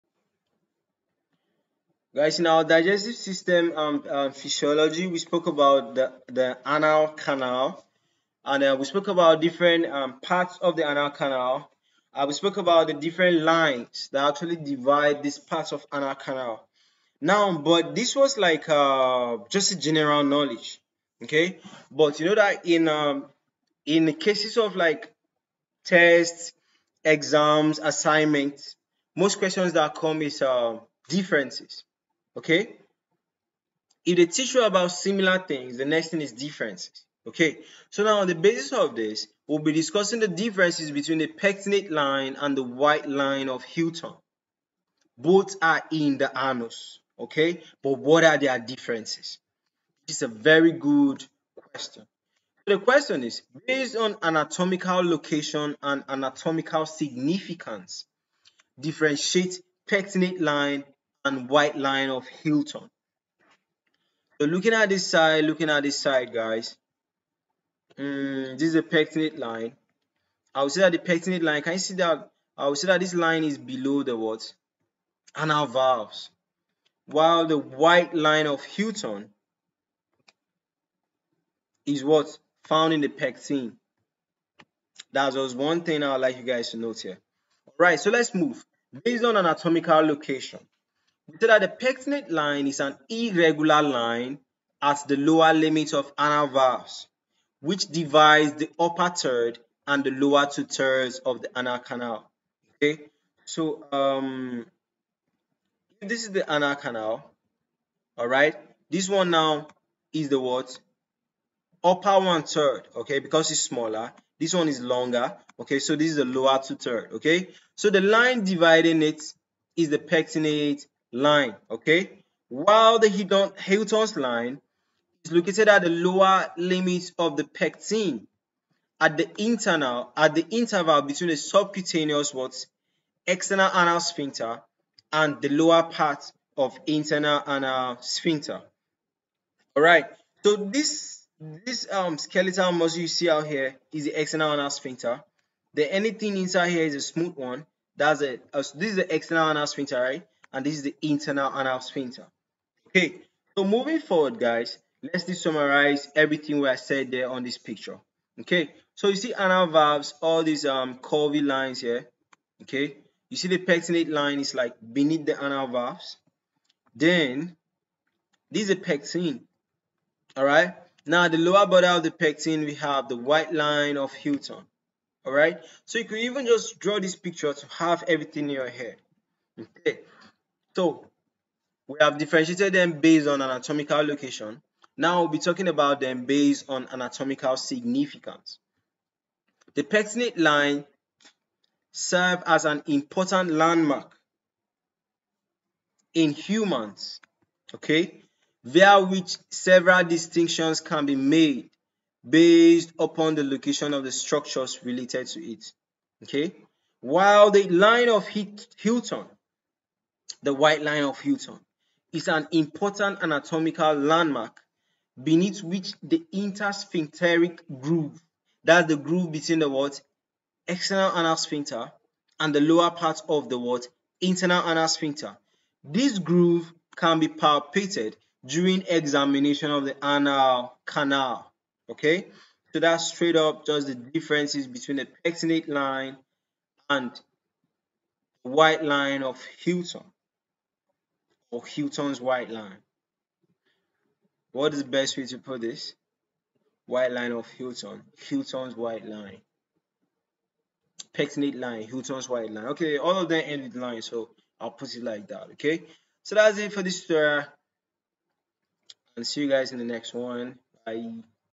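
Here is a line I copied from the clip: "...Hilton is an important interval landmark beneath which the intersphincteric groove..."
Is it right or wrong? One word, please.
wrong.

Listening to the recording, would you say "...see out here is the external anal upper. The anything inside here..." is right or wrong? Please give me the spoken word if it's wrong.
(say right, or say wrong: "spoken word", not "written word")
wrong: "sphincter", not "upper".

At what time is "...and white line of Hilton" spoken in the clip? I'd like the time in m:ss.
1:01.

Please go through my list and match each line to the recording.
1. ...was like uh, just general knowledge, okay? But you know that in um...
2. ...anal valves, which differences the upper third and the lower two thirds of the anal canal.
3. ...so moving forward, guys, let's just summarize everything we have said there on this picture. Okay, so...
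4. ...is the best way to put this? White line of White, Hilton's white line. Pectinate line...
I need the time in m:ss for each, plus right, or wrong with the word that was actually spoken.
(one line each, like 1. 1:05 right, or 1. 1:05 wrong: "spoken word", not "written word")
1. 0:18 right
2. 1:36 wrong: "divides", not "differences"
3. 2:33 right
4. 4:04 wrong: "Hilton", not "White".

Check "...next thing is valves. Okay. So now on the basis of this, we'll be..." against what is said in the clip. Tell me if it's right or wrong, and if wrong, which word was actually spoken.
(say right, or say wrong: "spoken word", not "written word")
wrong: "differences", not "valves".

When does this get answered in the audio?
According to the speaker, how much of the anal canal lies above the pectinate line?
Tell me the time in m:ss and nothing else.
1:51.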